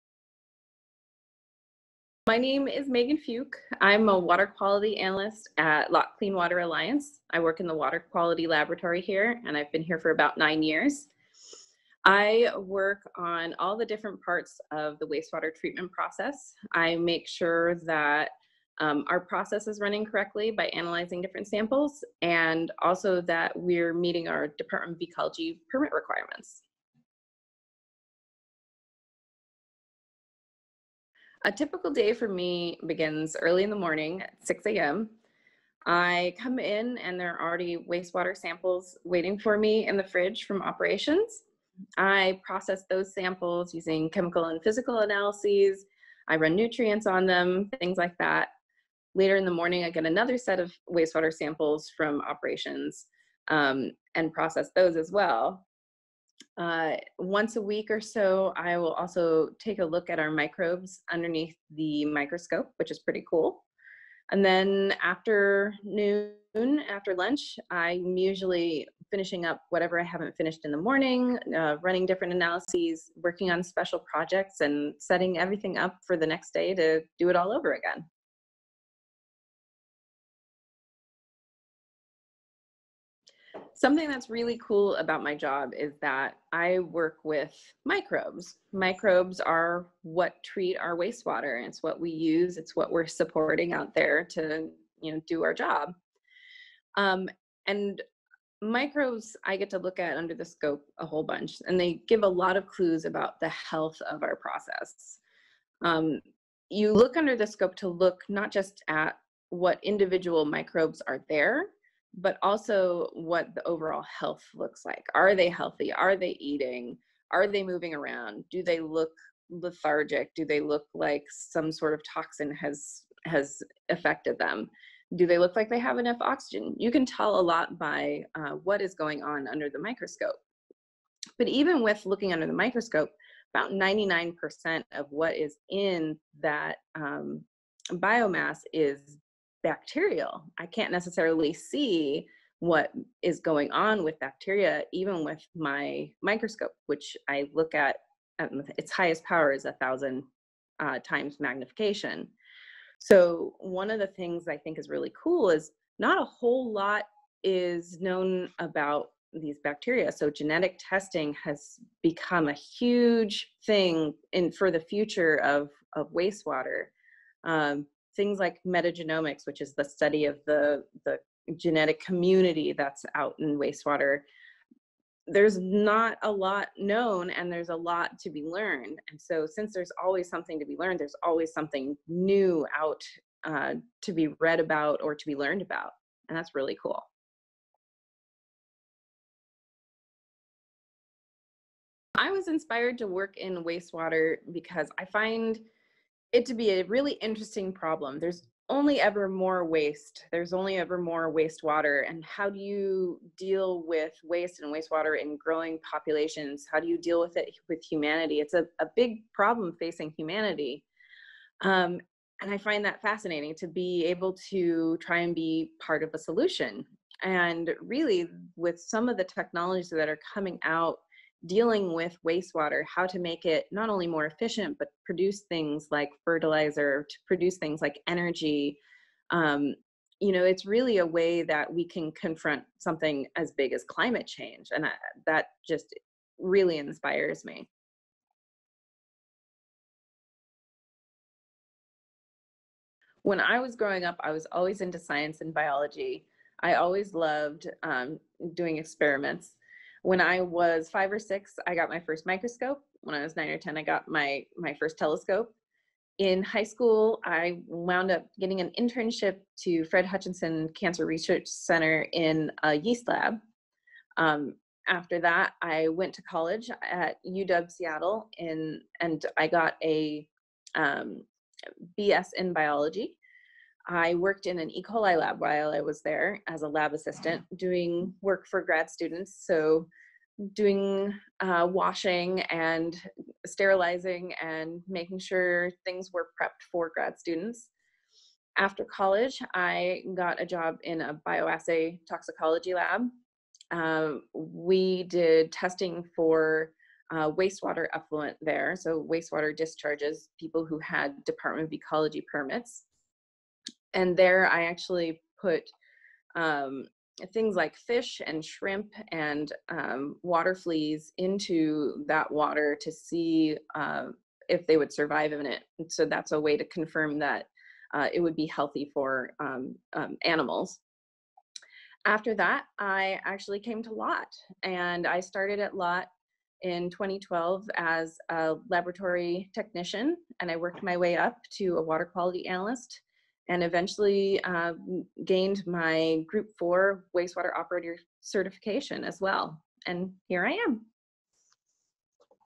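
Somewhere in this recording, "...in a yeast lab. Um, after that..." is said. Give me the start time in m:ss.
4:22.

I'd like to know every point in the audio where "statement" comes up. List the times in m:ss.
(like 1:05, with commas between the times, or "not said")
not said.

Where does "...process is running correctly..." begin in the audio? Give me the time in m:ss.
0:19.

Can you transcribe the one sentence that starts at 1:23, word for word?
Something that's really cool about my job is that I work with microbes.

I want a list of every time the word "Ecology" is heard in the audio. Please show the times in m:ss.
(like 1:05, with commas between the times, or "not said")
0:25, 5:01.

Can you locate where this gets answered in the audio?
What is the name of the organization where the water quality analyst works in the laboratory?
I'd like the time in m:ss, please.
0:05.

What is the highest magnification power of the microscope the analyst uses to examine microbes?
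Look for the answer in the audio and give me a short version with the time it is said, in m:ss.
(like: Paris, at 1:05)
1000 times, at 2:29.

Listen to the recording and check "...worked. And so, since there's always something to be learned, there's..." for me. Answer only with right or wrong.
wrong.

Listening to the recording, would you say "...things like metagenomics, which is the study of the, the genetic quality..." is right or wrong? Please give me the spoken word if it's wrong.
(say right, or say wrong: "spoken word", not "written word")
wrong: "community", not "quality".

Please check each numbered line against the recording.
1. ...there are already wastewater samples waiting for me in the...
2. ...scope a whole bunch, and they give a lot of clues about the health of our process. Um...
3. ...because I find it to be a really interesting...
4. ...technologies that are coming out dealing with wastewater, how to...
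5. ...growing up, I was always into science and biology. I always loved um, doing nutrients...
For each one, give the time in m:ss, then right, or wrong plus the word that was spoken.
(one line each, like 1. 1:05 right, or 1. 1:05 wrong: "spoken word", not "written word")
1. 0:37 right
2. 1:40 right
3. 3:14 right
4. 3:39 right
5. 4:03 wrong: "experiments", not "nutrients".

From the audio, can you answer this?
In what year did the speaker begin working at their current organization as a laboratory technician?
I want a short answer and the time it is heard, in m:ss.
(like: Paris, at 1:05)
2012, at 5:26.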